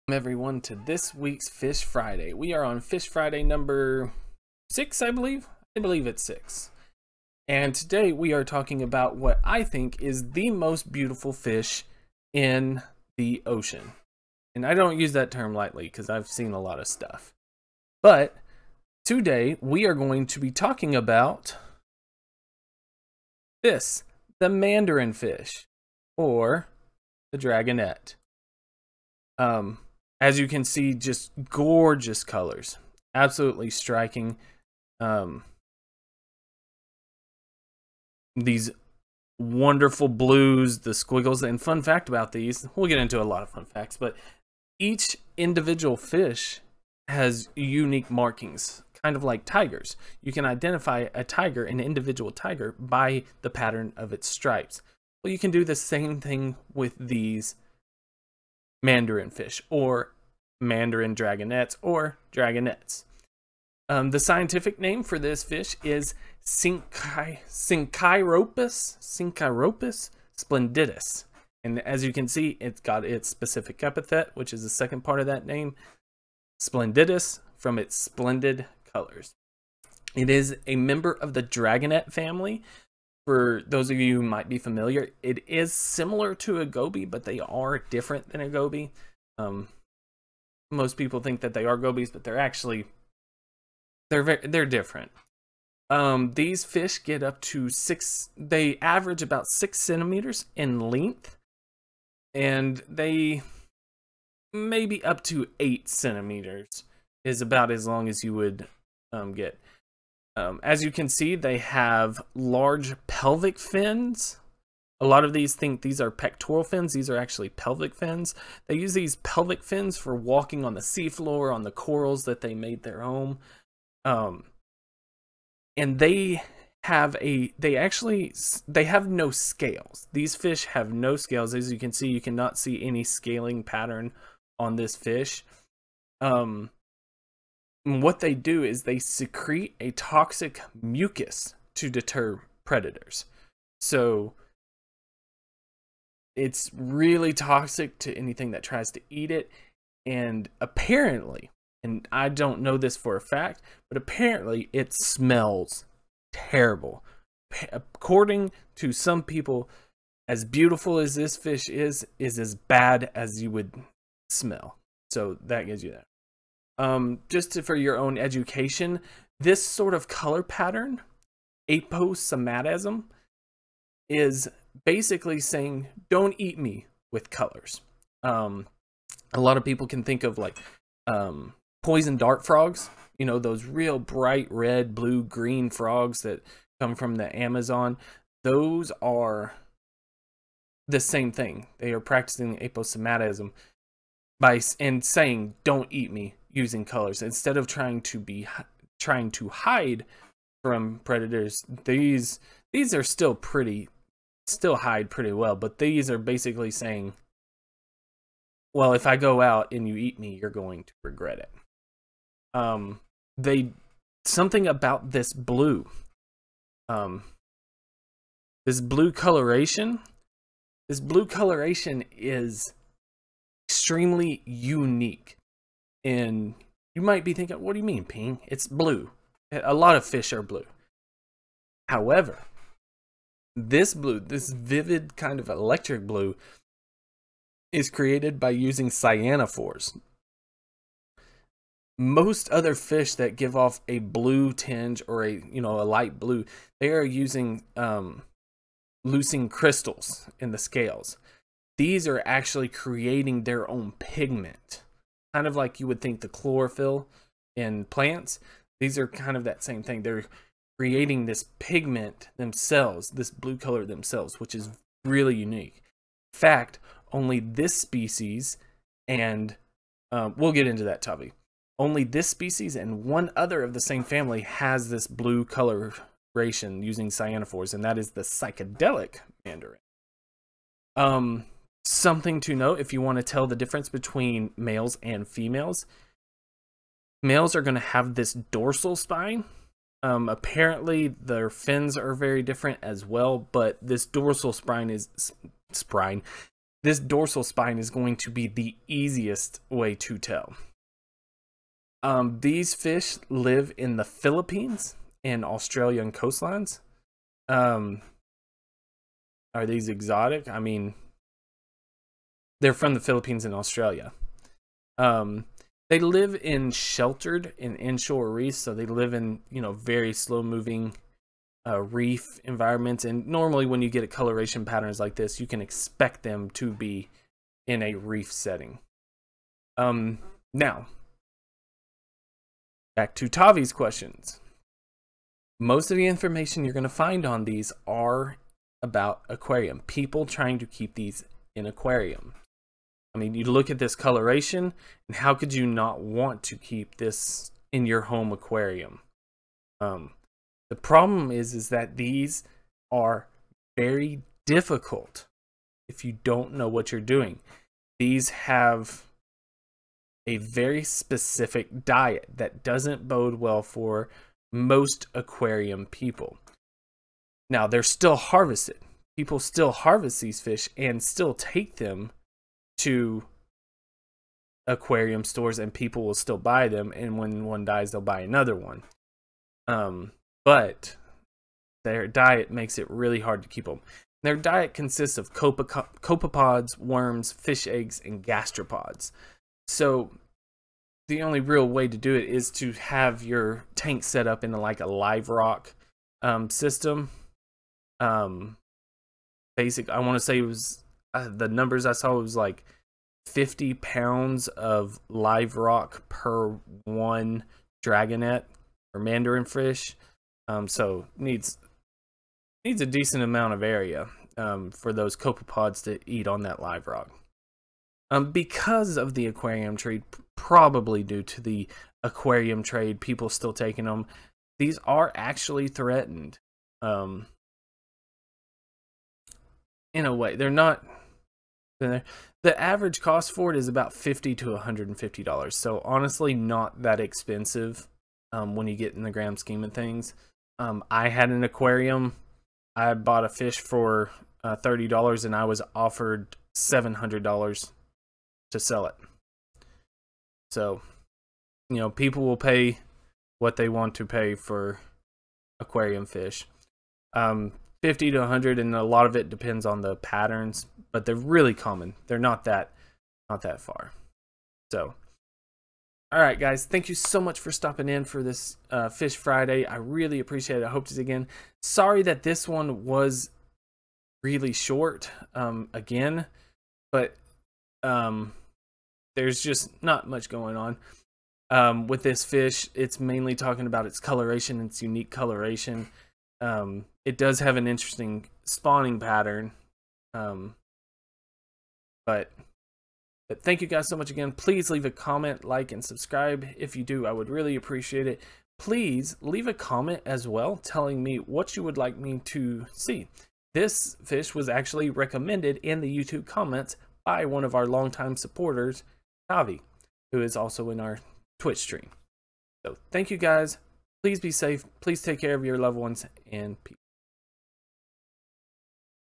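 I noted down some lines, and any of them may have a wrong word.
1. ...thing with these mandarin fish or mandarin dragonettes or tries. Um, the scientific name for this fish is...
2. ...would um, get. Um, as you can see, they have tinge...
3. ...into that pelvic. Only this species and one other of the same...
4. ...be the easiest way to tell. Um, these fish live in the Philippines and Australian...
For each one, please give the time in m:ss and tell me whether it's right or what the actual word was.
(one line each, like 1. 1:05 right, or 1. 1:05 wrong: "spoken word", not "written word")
1. 0:56 wrong: "dragonettes", not "tries"
2. 1:48 wrong: "large", not "tinge"
3. 4:30 wrong: "topic", not "pelvic"
4. 4:58 right.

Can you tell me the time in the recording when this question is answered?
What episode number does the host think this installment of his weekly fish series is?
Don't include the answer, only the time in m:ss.
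0:03.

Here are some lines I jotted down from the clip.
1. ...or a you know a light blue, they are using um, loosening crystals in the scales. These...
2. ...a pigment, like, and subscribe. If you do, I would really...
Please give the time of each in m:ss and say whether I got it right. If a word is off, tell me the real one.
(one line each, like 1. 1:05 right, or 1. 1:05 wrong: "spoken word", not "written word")
1. 4:05 right
2. 8:14 wrong: "comment", not "pigment".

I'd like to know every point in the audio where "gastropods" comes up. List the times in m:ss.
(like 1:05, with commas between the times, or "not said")
6:28.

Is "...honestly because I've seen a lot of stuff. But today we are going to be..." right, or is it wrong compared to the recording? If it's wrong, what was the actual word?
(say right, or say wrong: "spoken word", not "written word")
wrong: "lightly", not "honestly".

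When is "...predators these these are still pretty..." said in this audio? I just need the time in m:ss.
3:21.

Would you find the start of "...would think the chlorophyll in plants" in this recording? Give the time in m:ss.
4:15.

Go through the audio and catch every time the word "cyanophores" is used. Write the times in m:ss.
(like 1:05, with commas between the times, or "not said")
3:58, 4:37.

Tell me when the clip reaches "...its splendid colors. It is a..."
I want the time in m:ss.
1:17.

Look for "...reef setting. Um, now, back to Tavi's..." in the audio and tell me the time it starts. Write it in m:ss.
5:27.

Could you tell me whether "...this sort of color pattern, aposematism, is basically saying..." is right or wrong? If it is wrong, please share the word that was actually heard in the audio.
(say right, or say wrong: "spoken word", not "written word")
right.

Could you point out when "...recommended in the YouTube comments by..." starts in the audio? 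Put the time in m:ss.
8:24.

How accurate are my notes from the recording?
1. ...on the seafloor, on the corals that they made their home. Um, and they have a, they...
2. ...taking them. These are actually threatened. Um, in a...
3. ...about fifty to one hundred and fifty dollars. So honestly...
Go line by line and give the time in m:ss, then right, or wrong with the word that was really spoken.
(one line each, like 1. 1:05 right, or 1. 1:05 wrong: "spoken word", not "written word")
1. 2:00 right
2. 7:03 right
3. 7:13 right.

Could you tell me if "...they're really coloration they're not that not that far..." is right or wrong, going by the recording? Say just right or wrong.
wrong.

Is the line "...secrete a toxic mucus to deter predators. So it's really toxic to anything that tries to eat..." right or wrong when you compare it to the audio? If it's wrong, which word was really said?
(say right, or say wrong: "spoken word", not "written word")
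right.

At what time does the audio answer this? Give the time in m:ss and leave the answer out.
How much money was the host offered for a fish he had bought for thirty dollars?
7:26.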